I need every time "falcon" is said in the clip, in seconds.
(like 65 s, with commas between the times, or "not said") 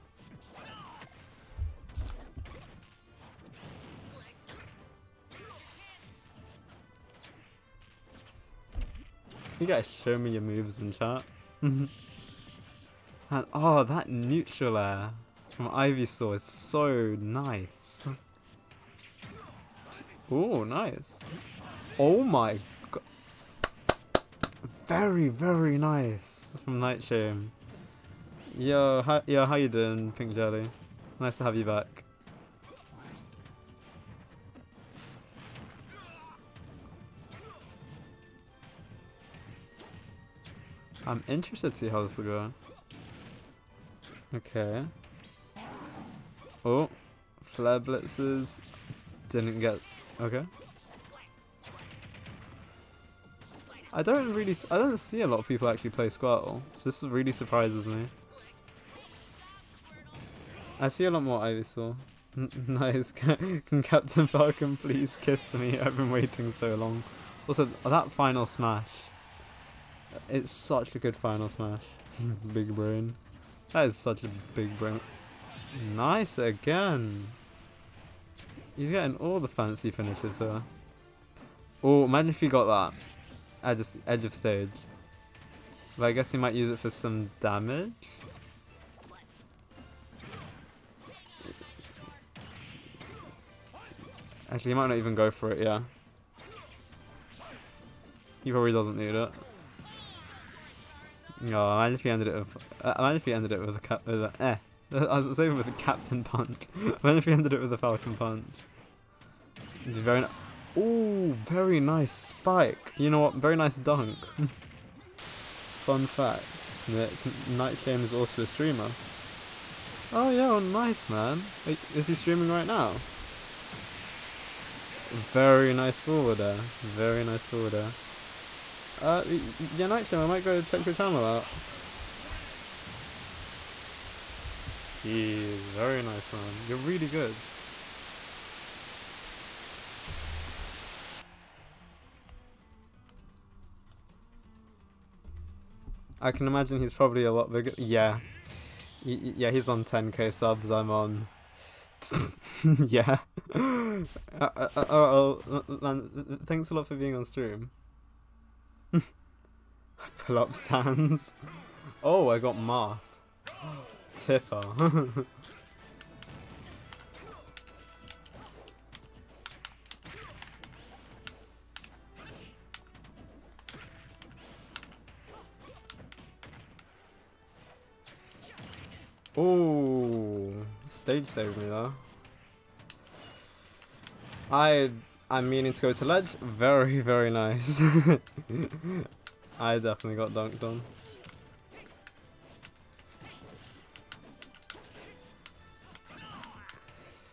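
64 s, 107 s.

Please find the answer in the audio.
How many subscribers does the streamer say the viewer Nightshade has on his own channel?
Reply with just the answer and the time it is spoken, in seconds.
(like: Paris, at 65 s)
10k, at 149 s.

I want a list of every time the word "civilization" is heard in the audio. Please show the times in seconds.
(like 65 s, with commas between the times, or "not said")
not said.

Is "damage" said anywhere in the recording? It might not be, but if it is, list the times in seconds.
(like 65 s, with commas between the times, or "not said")
87 s.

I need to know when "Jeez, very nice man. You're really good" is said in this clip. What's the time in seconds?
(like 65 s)
134 s.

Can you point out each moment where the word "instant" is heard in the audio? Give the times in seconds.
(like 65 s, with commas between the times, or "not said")
not said.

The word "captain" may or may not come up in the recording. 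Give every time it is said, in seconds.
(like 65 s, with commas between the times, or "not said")
63 s, 105 s.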